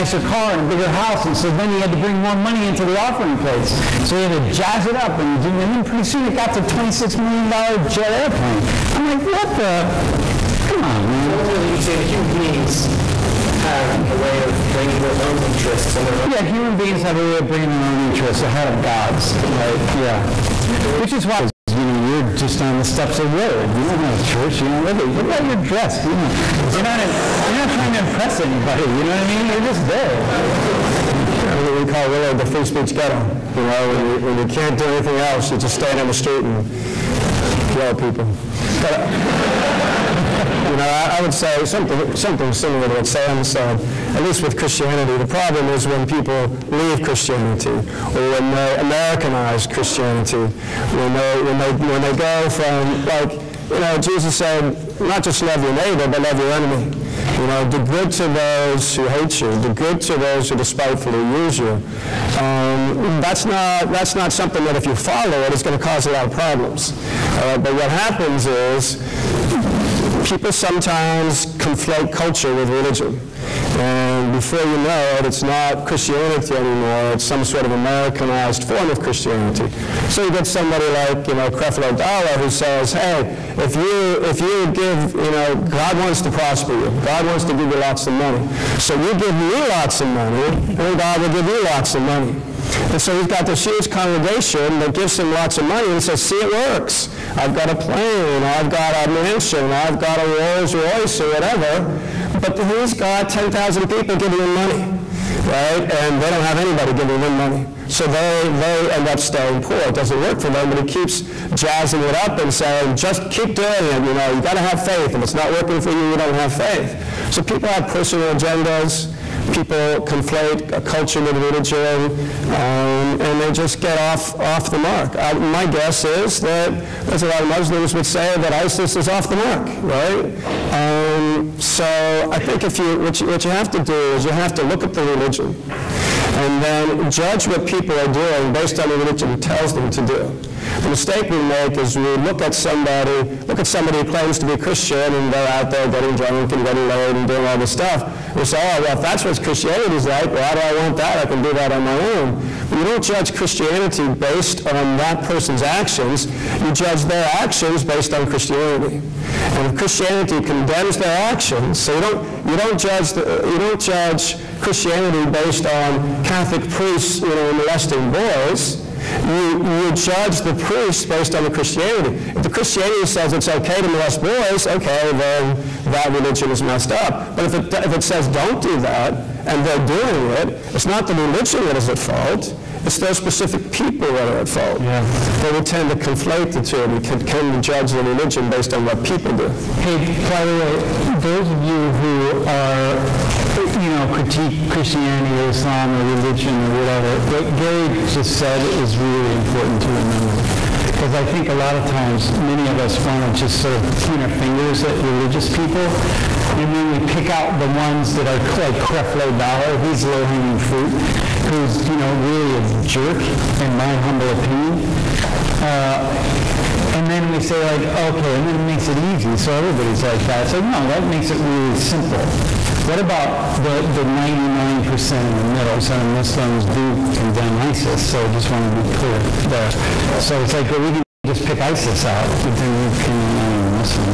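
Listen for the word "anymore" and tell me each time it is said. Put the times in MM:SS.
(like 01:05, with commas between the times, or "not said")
01:16.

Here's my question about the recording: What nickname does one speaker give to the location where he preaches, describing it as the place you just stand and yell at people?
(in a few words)
the free speech ghetto.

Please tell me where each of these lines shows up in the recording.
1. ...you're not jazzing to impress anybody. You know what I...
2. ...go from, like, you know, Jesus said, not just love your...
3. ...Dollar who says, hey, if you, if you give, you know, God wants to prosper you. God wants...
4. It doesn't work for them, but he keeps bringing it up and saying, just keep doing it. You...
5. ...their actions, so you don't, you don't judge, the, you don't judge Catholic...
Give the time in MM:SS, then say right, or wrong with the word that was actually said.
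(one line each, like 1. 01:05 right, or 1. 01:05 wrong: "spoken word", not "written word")
1. 00:27 wrong: "trying", not "jazzing"
2. 00:52 right
3. 01:21 right
4. 01:49 wrong: "jazzing", not "bringing"
5. 02:40 wrong: "Christianity", not "Catholic".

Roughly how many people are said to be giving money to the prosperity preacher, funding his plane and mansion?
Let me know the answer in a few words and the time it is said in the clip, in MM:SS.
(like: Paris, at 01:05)
10,000, at 01:43.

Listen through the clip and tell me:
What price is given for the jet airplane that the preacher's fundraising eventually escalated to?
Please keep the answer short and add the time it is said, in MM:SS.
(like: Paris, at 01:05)
$26 million, at 00:06.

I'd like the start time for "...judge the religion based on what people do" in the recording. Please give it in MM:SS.
03:07.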